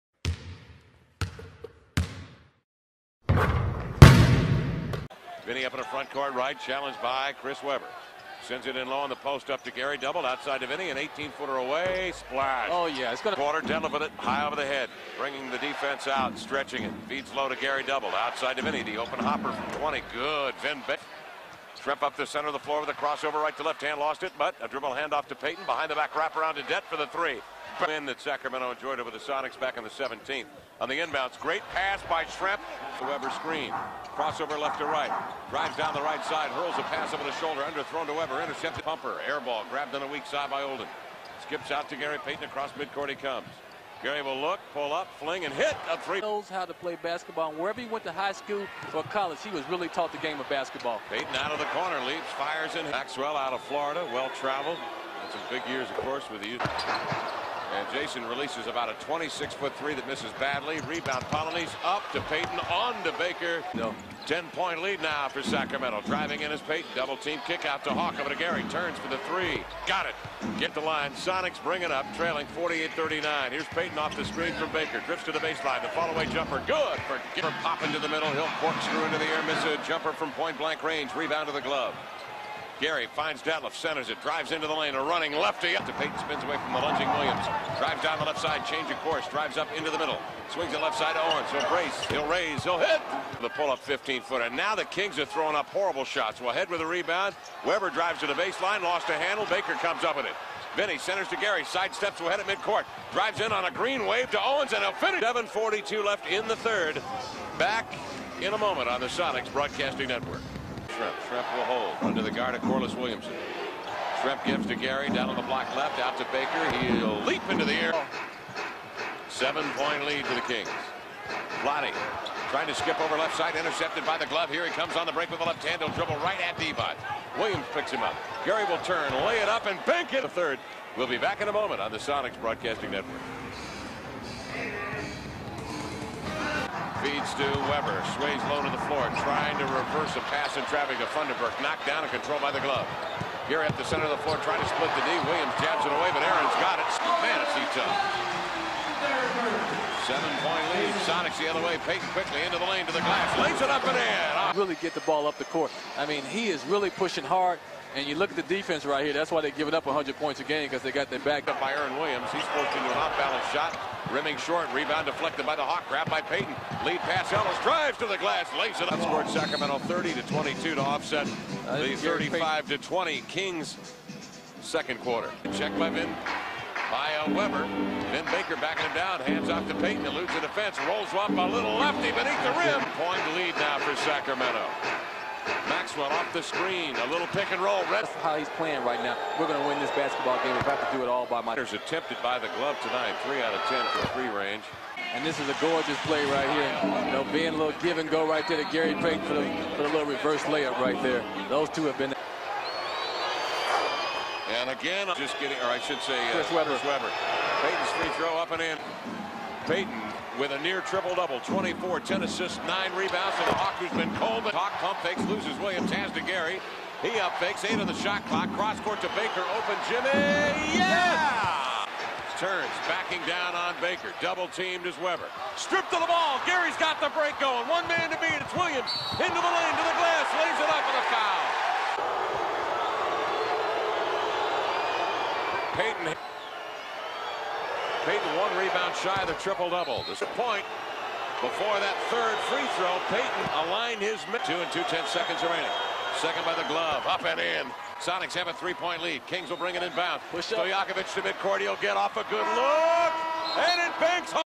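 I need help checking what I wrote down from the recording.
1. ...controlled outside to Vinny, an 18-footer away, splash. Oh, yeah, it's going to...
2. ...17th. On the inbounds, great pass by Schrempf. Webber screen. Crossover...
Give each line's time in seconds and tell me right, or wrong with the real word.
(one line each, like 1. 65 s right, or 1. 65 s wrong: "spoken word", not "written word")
1. 9 s wrong: "doubled", not "controlled"
2. 29 s right.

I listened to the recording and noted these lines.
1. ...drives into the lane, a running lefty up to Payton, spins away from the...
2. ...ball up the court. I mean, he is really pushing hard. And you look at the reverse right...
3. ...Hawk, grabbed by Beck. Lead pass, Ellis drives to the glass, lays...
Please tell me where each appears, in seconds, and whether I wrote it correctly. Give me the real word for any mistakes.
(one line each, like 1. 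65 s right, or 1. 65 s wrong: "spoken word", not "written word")
1. 84 s right
2. 155 s wrong: "defense", not "reverse"
3. 165 s wrong: "Payton", not "Beck".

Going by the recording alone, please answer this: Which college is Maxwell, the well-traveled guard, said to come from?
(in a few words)
Florida.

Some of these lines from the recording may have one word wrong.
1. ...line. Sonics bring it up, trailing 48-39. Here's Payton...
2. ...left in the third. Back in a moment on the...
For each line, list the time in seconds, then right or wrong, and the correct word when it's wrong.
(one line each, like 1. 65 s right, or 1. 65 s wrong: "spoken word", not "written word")
1. 70 s right
2. 106 s right.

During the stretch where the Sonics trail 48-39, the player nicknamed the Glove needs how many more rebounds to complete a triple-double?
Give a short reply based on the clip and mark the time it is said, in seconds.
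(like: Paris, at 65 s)
1, at 238 s.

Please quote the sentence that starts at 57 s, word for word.
And Jason releases about a 26-foot three that misses badly.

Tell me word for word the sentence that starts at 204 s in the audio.
And again, just getting, or I should say, uh, Chris Chris Payton's free throw up and in.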